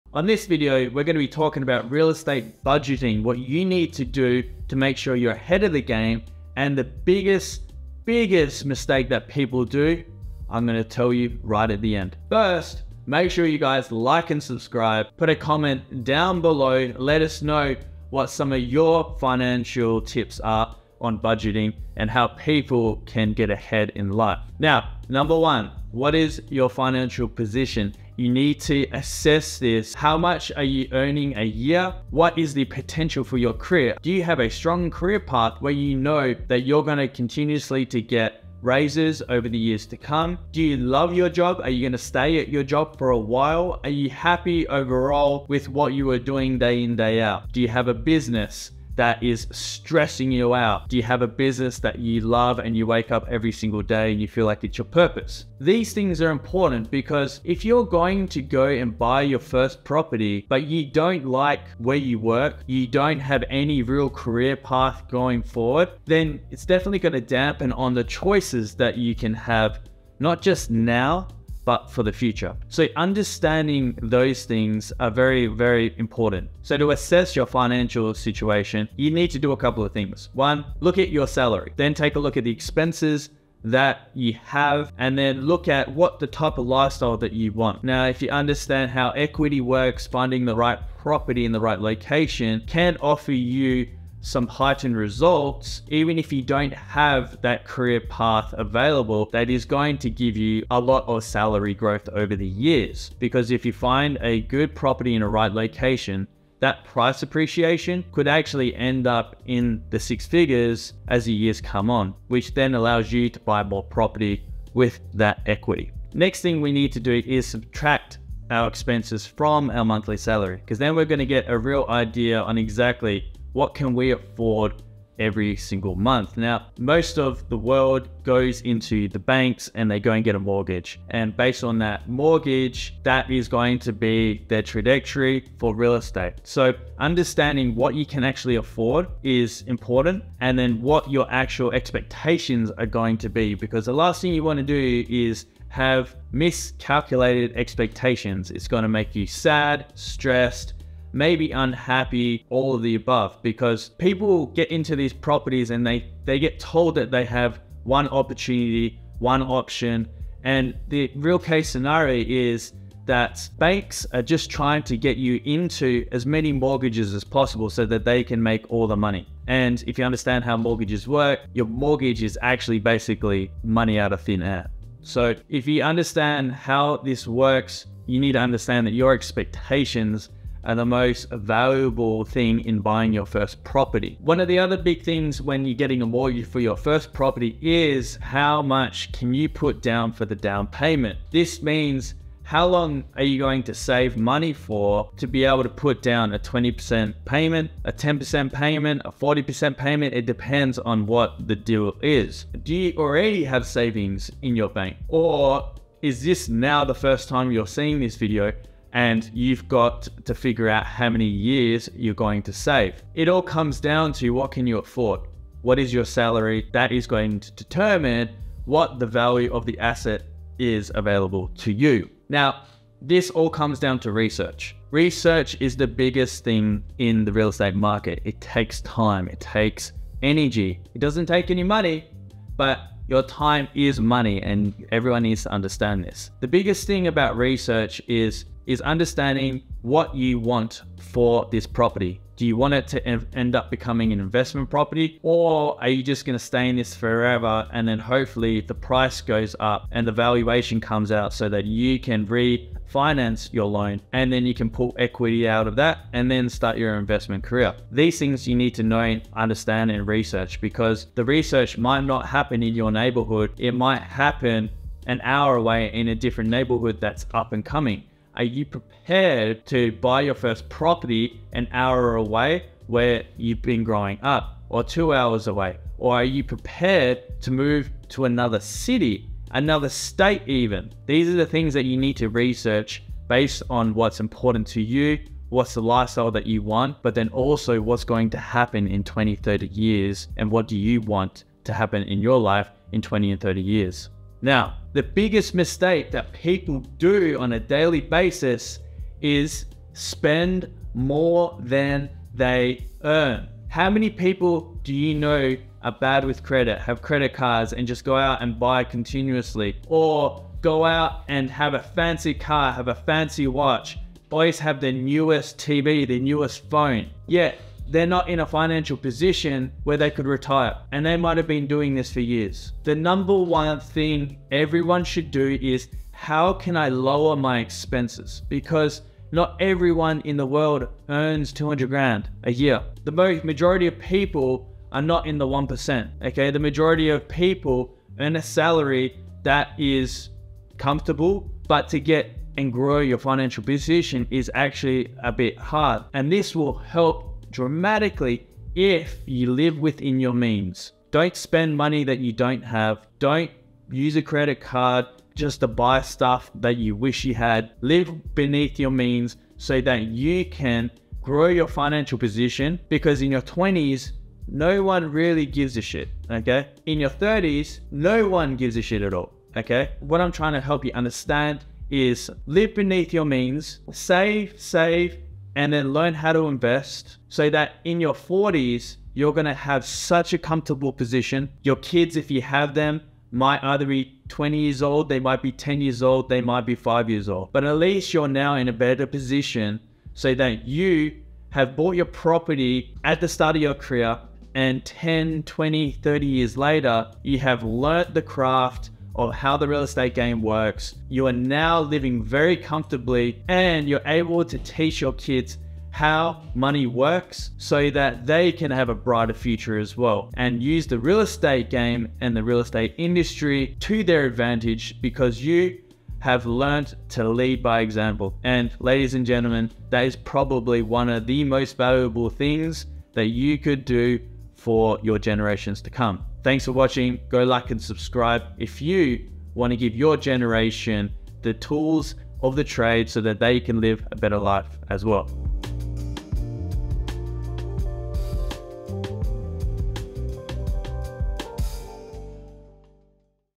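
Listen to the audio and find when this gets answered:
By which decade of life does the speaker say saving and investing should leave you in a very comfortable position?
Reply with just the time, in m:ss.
6:17.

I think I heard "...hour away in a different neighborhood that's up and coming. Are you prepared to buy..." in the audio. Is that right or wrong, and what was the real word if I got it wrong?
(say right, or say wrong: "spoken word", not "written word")
right.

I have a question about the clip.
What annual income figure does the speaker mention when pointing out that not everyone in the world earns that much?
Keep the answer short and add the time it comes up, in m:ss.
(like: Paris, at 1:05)
200 grand, at 5:31.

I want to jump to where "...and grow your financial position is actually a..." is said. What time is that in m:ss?
5:42.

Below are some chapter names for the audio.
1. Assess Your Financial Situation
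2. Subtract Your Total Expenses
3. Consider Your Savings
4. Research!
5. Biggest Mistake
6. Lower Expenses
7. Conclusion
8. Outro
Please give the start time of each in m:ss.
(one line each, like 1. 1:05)
1. 0:25
2. 1:58
3. 3:08
4. 3:44
5. 4:55
6. 5:24
7. 6:10
8. 7:06.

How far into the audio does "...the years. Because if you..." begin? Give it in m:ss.
1:42.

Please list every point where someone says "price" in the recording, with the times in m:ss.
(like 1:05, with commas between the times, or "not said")
1:46, 4:08.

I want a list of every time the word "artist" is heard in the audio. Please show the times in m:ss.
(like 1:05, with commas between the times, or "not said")
not said.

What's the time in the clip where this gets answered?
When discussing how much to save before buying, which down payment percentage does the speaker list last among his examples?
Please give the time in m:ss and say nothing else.
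3:19.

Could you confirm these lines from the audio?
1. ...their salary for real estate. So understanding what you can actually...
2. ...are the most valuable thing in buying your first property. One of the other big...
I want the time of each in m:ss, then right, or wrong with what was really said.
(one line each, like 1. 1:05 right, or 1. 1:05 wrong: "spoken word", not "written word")
1. 2:14 wrong: "trajectory", not "salary"
2. 3:00 right.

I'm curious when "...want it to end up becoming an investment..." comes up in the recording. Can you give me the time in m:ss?
4:02.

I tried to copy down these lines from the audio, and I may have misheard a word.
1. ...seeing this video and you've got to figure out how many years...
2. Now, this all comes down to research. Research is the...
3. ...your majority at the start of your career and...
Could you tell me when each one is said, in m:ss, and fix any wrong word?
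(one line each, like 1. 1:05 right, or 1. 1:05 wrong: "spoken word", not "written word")
1. 3:27 right
2. 3:42 right
3. 6:31 wrong: "property", not "majority".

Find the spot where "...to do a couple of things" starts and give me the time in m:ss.
1:19.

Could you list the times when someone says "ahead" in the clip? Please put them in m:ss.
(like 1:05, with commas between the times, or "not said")
0:05, 0:23.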